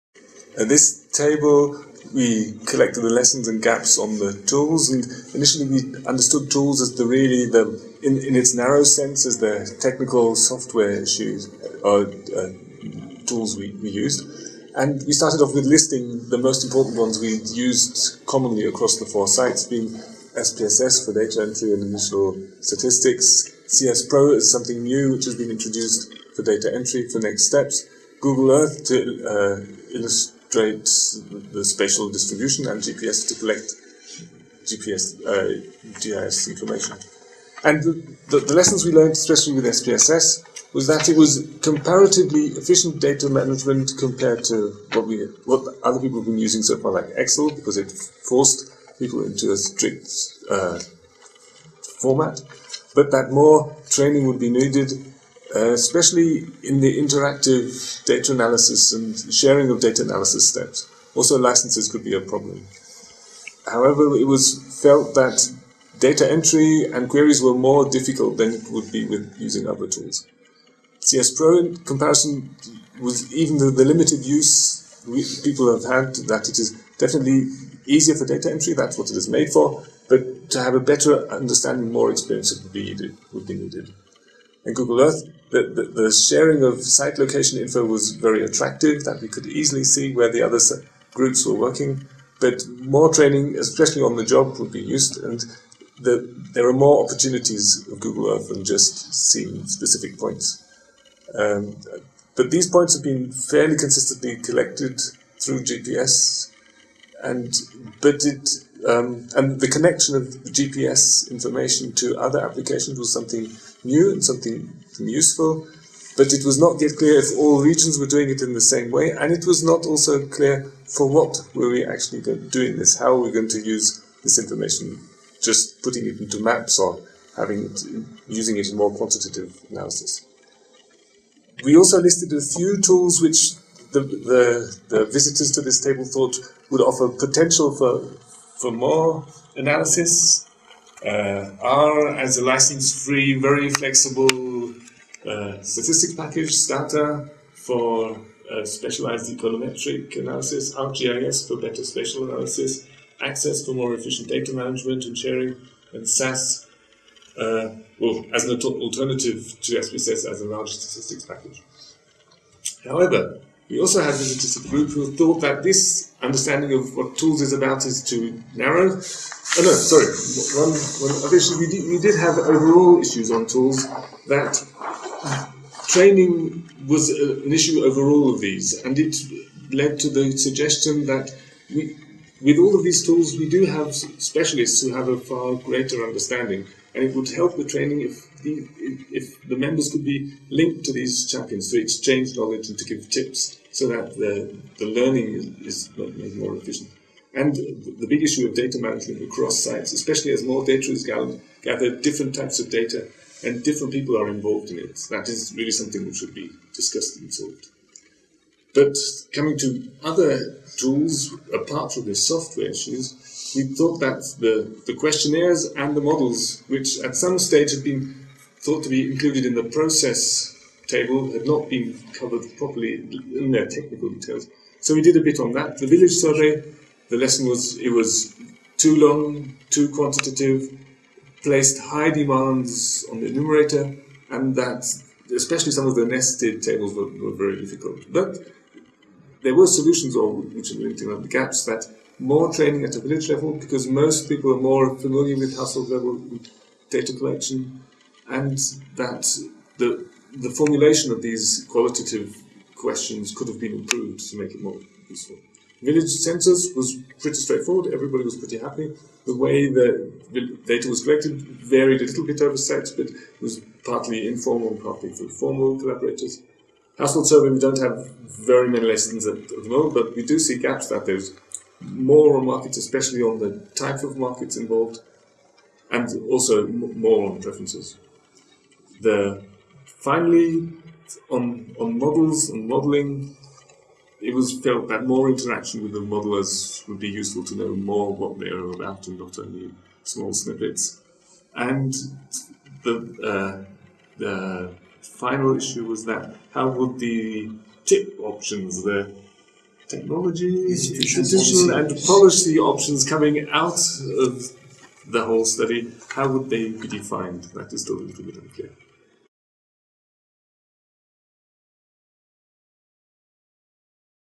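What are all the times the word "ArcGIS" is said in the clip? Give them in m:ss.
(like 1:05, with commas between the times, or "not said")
2:30.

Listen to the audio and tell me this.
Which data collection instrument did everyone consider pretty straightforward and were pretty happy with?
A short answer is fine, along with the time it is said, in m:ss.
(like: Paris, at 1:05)
Village census, at 4:15.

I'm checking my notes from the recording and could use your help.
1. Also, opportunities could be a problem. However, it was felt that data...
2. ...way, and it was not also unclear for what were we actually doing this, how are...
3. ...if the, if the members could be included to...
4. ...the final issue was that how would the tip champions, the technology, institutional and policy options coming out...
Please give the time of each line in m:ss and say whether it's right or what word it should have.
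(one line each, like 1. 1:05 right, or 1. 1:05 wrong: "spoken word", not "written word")
1. 1:01 wrong: "licenses", not "opportunities"
2. 1:58 wrong: "clear", not "unclear"
3. 3:08 wrong: "linked", not "included"
4. 4:54 wrong: "options", not "champions".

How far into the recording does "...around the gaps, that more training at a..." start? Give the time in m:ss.
4:01.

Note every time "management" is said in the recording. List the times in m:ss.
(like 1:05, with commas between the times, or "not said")
0:43, 2:34, 3:18.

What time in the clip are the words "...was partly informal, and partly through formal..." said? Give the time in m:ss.
4:23.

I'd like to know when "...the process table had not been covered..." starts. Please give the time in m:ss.
3:39.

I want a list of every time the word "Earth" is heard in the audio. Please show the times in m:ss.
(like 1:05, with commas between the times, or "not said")
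0:28, 1:25, 1:38.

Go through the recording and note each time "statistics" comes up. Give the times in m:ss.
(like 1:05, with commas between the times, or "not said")
0:22, 2:25, 2:40.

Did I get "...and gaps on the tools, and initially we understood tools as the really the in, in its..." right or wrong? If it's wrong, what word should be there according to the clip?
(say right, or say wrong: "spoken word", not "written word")
right.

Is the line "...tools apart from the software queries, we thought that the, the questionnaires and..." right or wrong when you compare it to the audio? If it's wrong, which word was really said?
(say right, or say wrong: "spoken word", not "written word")
wrong: "issues", not "queries".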